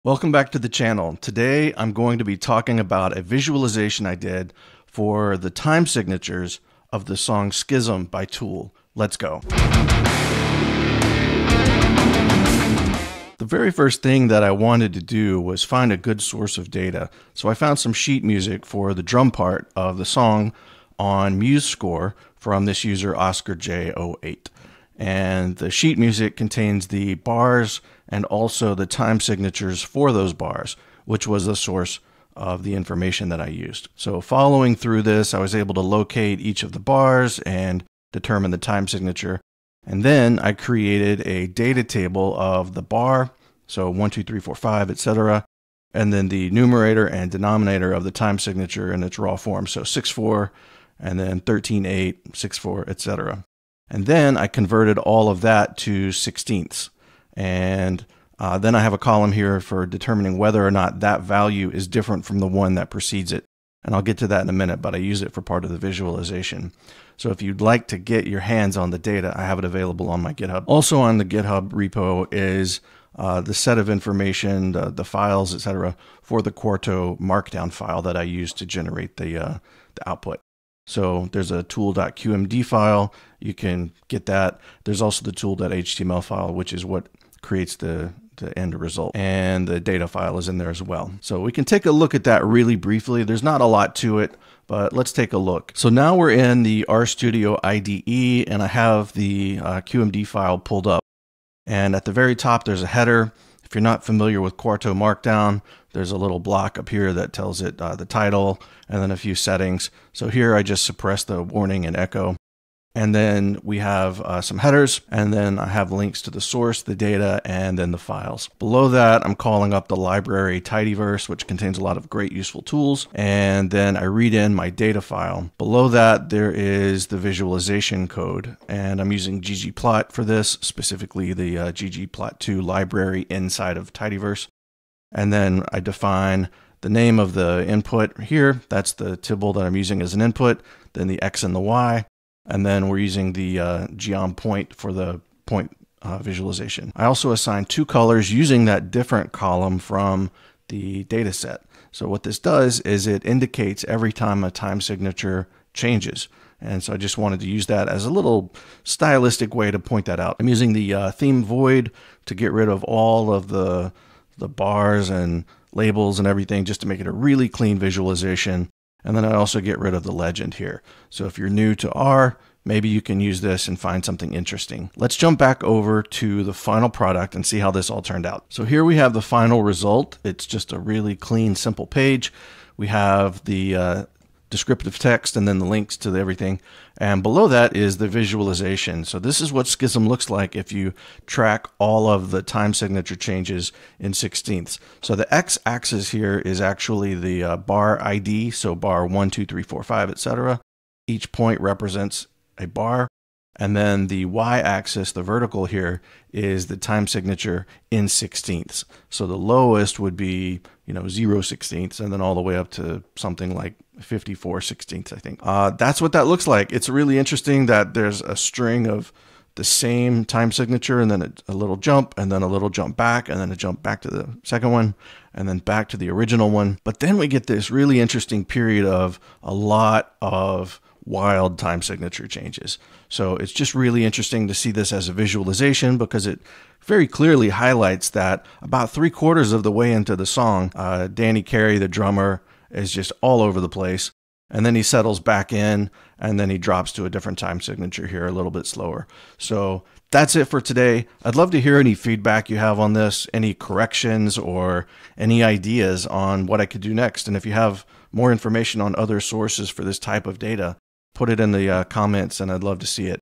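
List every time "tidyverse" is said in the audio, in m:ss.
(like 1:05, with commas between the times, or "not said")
2:00, 2:13.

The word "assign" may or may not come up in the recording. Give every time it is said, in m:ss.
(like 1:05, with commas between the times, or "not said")
2:27.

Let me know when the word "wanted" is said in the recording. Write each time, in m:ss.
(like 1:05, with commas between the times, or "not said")
0:14, 2:37.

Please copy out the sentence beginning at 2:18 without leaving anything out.
That's the tibble that I'm using as an input, then the X and the Y.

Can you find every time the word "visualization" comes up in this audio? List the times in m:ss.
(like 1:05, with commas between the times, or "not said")
0:03, 1:05, 2:07, 2:26, 2:47, 3:08, 3:55.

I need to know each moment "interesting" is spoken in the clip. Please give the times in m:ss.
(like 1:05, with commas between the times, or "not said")
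2:54, 3:37, 3:47, 3:54.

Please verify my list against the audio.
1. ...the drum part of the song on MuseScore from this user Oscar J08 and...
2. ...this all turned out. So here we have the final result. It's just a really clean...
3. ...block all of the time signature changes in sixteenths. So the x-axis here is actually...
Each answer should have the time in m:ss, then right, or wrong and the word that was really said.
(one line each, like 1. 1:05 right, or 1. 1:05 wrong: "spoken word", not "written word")
1. 0:18 right
2. 2:57 right
3. 3:11 wrong: "track", not "block".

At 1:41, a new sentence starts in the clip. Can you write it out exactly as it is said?
And at the very top, there's a header.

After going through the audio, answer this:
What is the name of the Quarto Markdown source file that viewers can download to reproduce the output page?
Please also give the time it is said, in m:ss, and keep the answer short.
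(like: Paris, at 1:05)
tool.qmd, at 1:21.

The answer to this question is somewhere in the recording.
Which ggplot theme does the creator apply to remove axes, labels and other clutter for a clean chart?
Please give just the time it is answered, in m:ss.
2:41.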